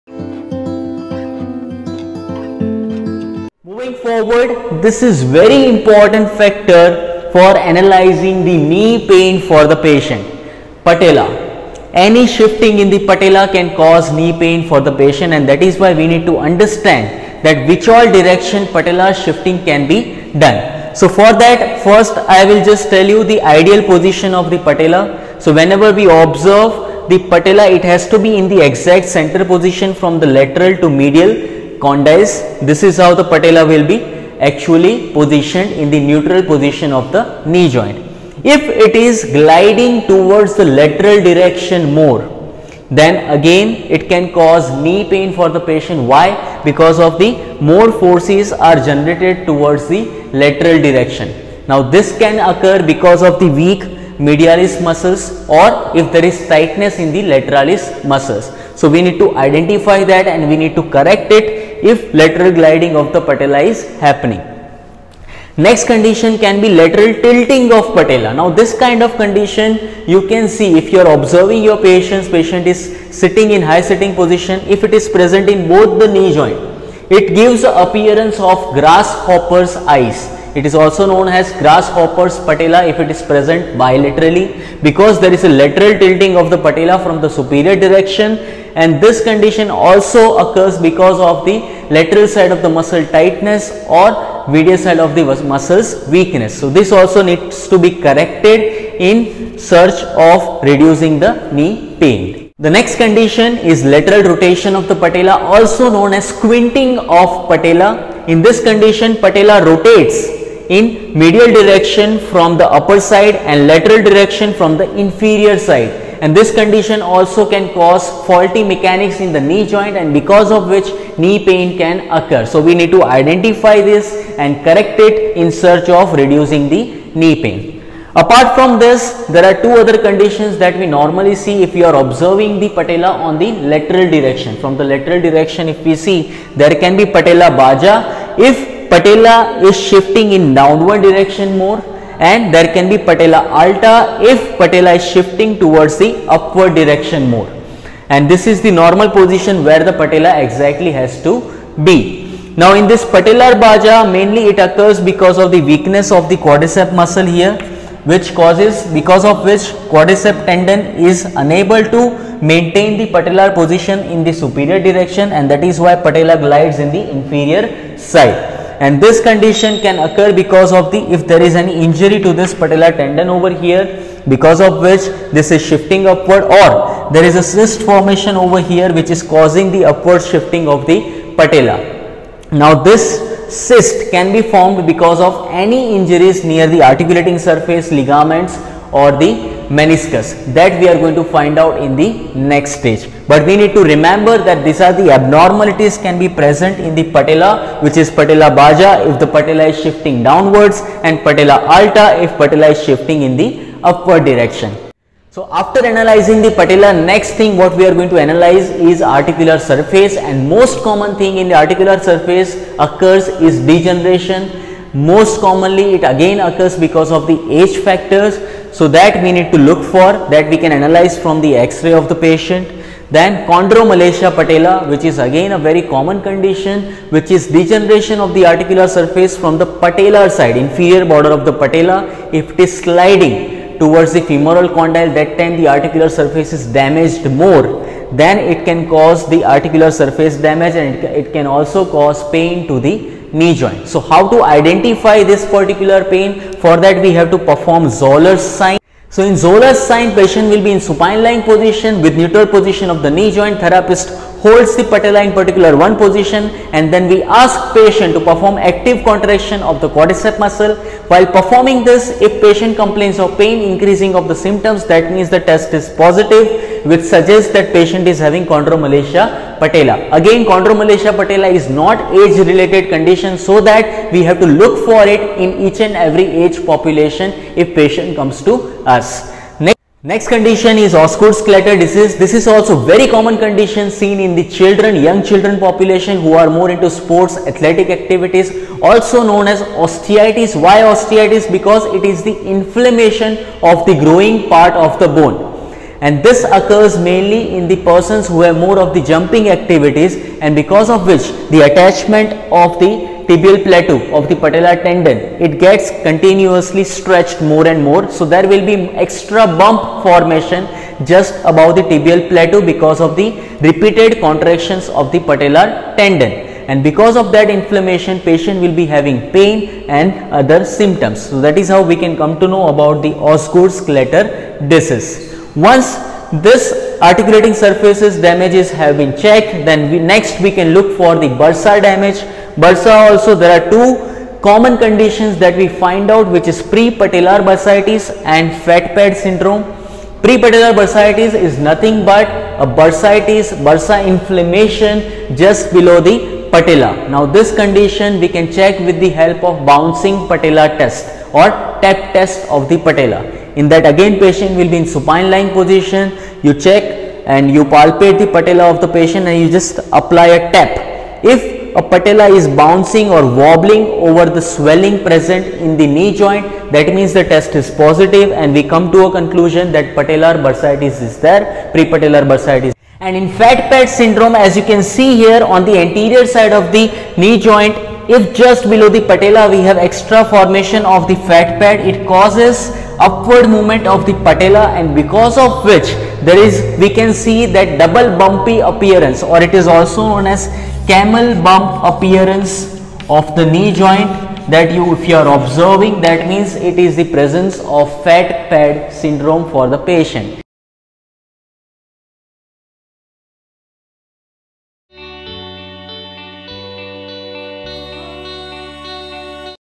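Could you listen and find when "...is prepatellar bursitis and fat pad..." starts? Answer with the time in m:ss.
5:36.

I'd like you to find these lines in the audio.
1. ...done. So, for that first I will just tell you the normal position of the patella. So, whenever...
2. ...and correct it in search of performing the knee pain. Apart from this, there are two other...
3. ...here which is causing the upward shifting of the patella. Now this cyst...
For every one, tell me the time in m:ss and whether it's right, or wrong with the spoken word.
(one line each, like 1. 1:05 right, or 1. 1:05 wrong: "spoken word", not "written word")
1. 0:20 wrong: "ideal", not "normal"
2. 2:04 wrong: "reducing", not "performing"
3. 2:58 right.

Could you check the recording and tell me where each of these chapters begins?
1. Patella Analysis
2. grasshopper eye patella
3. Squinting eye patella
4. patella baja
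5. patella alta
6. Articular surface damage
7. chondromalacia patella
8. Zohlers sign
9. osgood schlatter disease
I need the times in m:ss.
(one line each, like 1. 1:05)
1. 0:12
2. 1:07
3. 1:47
4. 2:18
5. 2:50
6. 3:28
7. 3:45
8. 4:08
9. 4:42.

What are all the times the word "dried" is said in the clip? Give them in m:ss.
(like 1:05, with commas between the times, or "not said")
not said.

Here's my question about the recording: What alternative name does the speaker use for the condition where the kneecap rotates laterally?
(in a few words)
Squinting of patella.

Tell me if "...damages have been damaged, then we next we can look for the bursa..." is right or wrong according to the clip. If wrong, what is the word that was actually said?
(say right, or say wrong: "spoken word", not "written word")
wrong: "checked", not "damaged".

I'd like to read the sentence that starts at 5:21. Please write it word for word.
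So, that is how we can come to know about the Osgood Schlatter disease.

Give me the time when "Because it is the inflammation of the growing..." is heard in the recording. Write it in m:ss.
4:51.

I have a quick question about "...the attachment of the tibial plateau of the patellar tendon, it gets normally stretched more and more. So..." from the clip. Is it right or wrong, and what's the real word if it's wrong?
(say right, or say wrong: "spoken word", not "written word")
wrong: "continuously", not "normally".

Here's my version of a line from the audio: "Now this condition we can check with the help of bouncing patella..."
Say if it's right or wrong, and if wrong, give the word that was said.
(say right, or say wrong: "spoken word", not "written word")
right.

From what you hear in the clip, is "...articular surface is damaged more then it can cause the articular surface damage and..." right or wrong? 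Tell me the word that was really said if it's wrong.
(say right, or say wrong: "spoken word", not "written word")
right.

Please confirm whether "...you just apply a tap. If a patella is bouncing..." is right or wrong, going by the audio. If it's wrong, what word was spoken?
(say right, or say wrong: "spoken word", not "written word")
right.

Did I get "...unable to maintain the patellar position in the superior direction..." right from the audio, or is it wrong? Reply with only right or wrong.
right.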